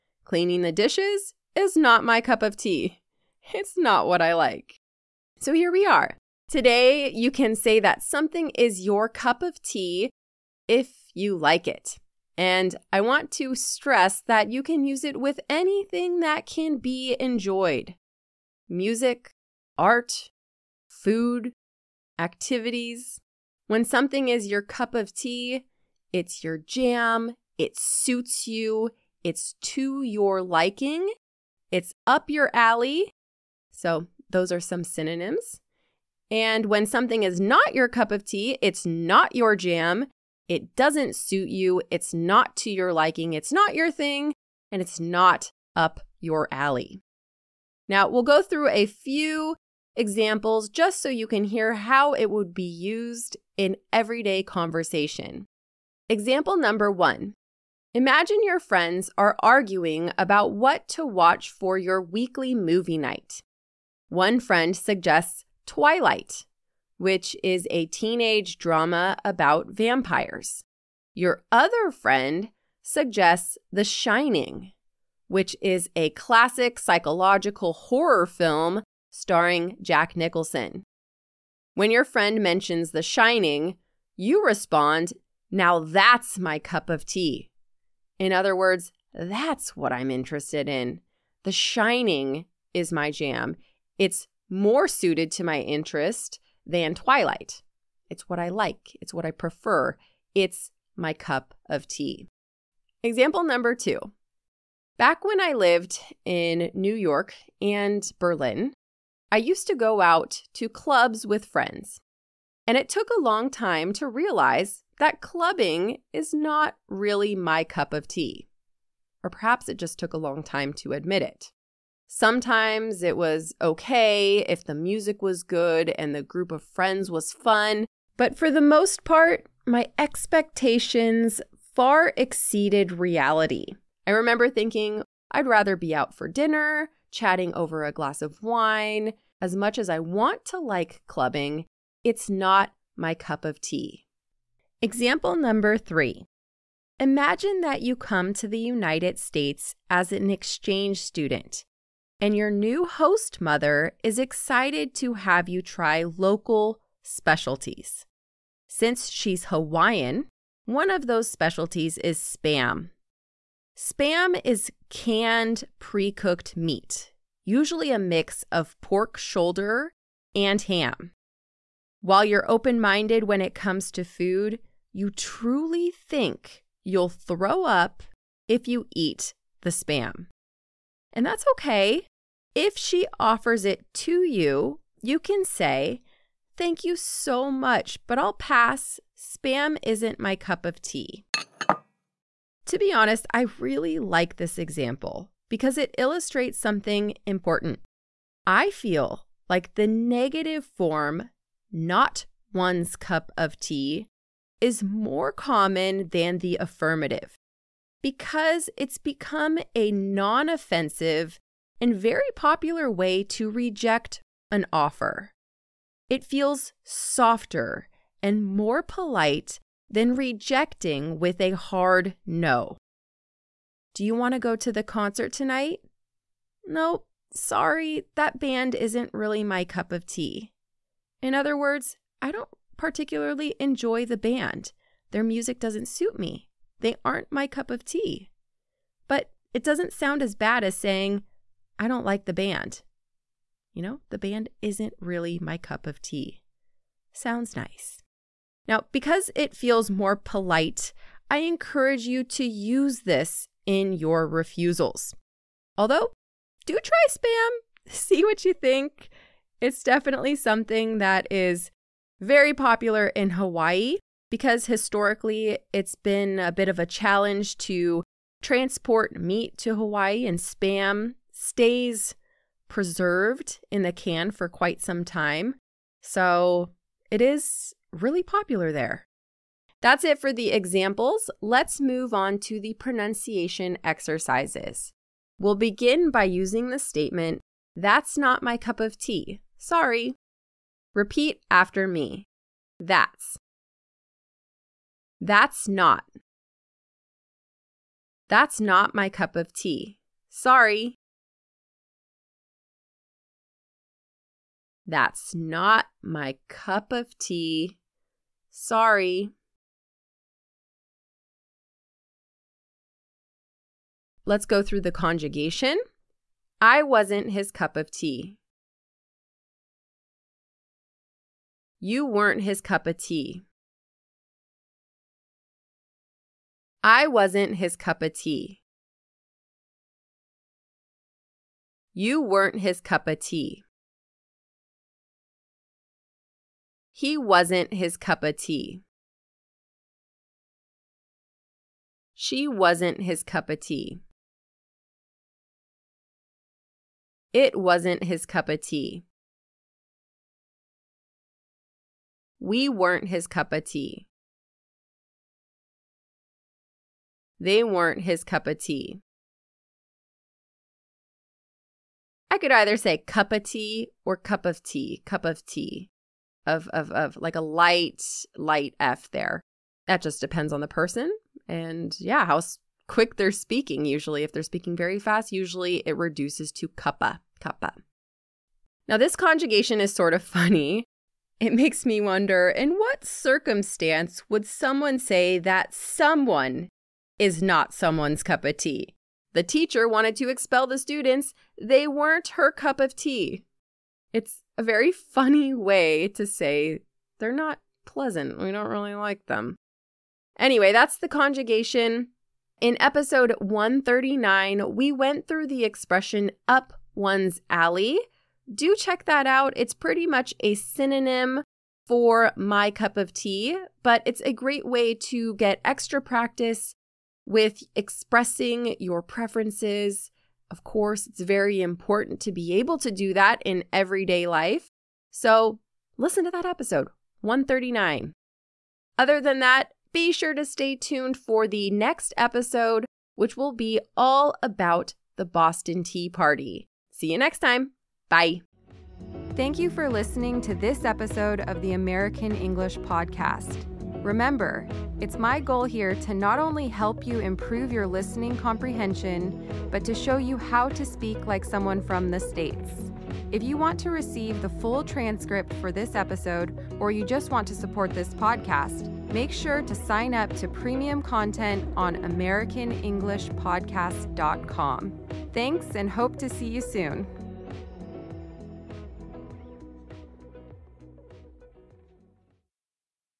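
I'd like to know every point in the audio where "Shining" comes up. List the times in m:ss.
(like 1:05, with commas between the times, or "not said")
1:13, 1:23, 1:31.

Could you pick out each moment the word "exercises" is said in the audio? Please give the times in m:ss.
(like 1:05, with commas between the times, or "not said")
4:43.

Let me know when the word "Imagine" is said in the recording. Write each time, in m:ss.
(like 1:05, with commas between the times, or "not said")
0:57, 2:26.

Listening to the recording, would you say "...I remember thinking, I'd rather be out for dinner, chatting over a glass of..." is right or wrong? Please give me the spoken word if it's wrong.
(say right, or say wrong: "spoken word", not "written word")
right.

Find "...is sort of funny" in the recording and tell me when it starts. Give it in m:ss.
6:19.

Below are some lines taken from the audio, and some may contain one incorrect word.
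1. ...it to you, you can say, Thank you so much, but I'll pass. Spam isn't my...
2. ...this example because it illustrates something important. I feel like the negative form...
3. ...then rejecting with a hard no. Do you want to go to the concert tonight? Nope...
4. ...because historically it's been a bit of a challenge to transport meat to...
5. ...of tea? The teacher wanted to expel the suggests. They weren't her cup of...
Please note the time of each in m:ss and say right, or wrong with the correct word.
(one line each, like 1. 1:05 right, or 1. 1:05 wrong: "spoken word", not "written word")
1. 3:03 right
2. 3:14 right
3. 3:39 right
4. 4:24 right
5. 6:28 wrong: "students", not "suggests".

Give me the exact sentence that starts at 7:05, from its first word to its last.
So listen to that episode, 139.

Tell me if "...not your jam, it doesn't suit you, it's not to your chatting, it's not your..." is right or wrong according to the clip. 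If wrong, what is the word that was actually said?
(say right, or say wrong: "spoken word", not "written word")
wrong: "liking", not "chatting".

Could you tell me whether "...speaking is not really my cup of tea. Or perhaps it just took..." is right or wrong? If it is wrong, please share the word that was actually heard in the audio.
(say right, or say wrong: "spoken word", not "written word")
wrong: "clubbing", not "speaking".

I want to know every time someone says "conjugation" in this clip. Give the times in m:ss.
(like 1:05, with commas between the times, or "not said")
5:14, 6:19, 6:41.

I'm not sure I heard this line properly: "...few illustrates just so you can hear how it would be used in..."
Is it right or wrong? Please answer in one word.
wrong.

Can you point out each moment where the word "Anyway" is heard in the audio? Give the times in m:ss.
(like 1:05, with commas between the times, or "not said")
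6:40.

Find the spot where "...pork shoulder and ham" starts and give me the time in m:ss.
2:48.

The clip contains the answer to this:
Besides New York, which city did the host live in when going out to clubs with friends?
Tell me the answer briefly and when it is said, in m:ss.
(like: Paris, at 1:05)
Berlin, at 1:48.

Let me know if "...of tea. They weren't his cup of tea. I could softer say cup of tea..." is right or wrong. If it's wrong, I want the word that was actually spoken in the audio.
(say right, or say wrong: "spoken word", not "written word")
wrong: "either", not "softer".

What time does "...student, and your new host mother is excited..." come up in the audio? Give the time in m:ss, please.
2:31.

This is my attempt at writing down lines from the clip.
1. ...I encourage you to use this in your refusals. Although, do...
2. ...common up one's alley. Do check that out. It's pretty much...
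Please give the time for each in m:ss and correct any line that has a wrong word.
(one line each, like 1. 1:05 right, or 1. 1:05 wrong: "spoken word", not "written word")
1. 4:11 right
2. 6:45 wrong: "expression", not "common".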